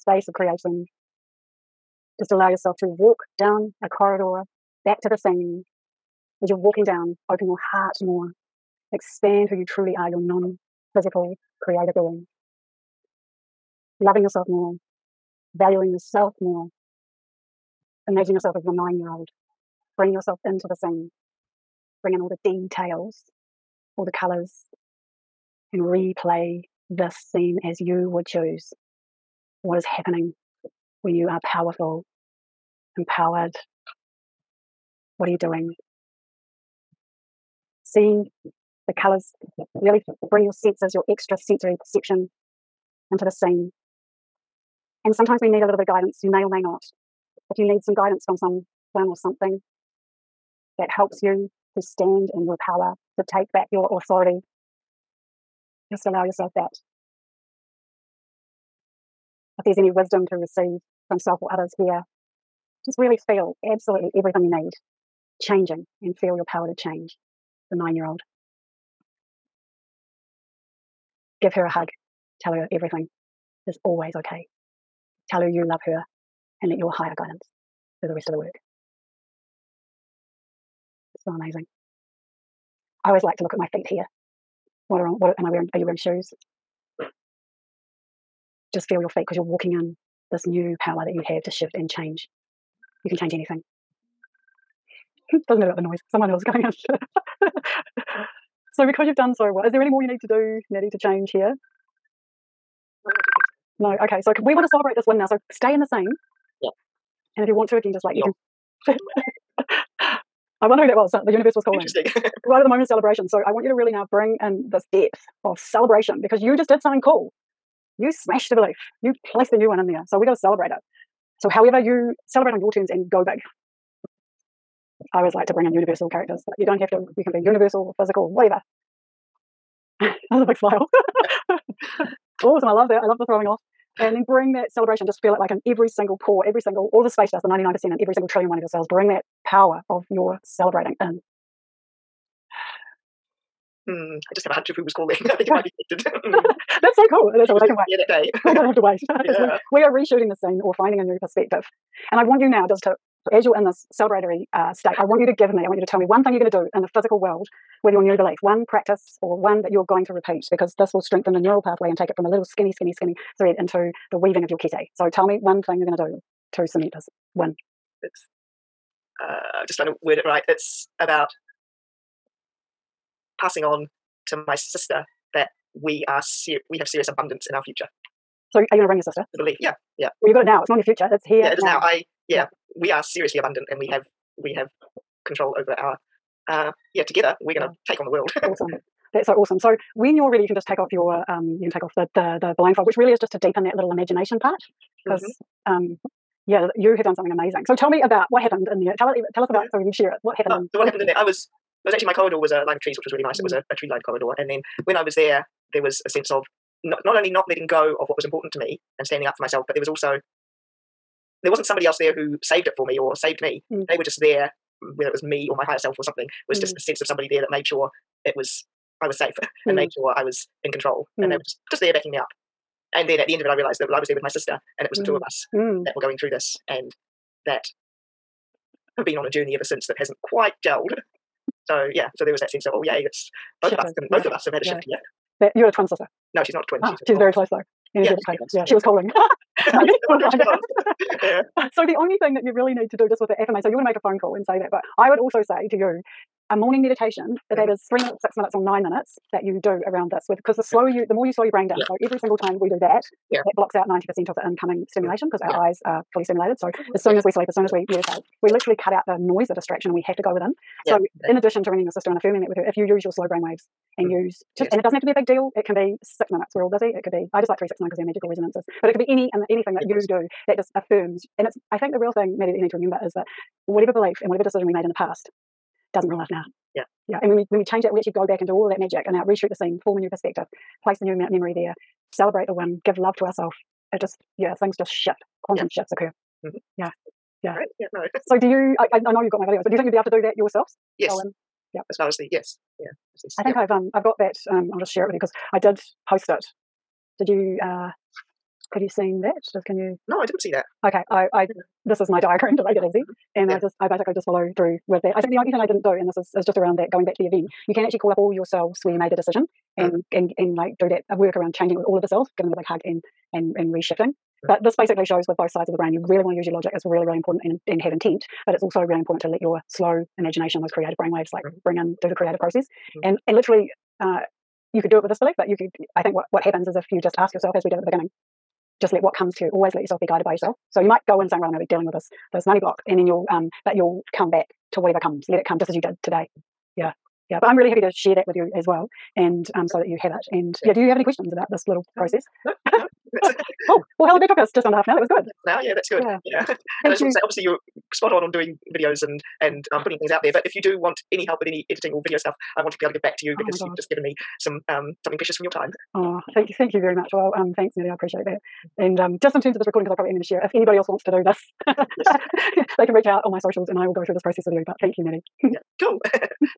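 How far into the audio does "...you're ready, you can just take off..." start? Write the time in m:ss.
3:10.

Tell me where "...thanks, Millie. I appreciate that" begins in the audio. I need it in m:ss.
5:57.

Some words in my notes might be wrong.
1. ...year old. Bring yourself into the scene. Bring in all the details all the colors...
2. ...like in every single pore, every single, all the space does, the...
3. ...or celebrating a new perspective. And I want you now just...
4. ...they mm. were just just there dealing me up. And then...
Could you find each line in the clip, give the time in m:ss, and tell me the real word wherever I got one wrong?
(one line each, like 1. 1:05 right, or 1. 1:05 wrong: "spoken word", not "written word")
1. 0:18 right
2. 2:15 right
3. 2:30 wrong: "finding", not "celebrating"
4. 3:41 wrong: "backing", not "dealing".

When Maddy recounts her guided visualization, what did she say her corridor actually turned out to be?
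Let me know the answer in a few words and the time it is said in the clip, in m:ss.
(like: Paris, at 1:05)
A line of trees, at 3:22.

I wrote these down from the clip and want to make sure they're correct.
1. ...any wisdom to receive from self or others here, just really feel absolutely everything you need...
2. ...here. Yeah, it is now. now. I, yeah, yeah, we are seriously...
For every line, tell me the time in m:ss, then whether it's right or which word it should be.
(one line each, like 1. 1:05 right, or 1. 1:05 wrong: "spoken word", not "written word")
1. 0:59 right
2. 3:01 right.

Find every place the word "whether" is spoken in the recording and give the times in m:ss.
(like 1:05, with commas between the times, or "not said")
3:34.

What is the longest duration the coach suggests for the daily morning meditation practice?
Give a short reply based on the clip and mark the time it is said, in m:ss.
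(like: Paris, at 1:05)
9 minutes, at 4:08.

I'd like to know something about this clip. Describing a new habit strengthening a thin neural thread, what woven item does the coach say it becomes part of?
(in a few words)
kete.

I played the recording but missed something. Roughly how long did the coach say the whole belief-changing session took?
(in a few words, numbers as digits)
Just under half an hour.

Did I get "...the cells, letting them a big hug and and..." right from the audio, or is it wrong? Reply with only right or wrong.
wrong.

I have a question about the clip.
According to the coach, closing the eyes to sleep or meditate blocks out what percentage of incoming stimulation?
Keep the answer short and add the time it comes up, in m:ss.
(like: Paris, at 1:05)
90%, at 4:13.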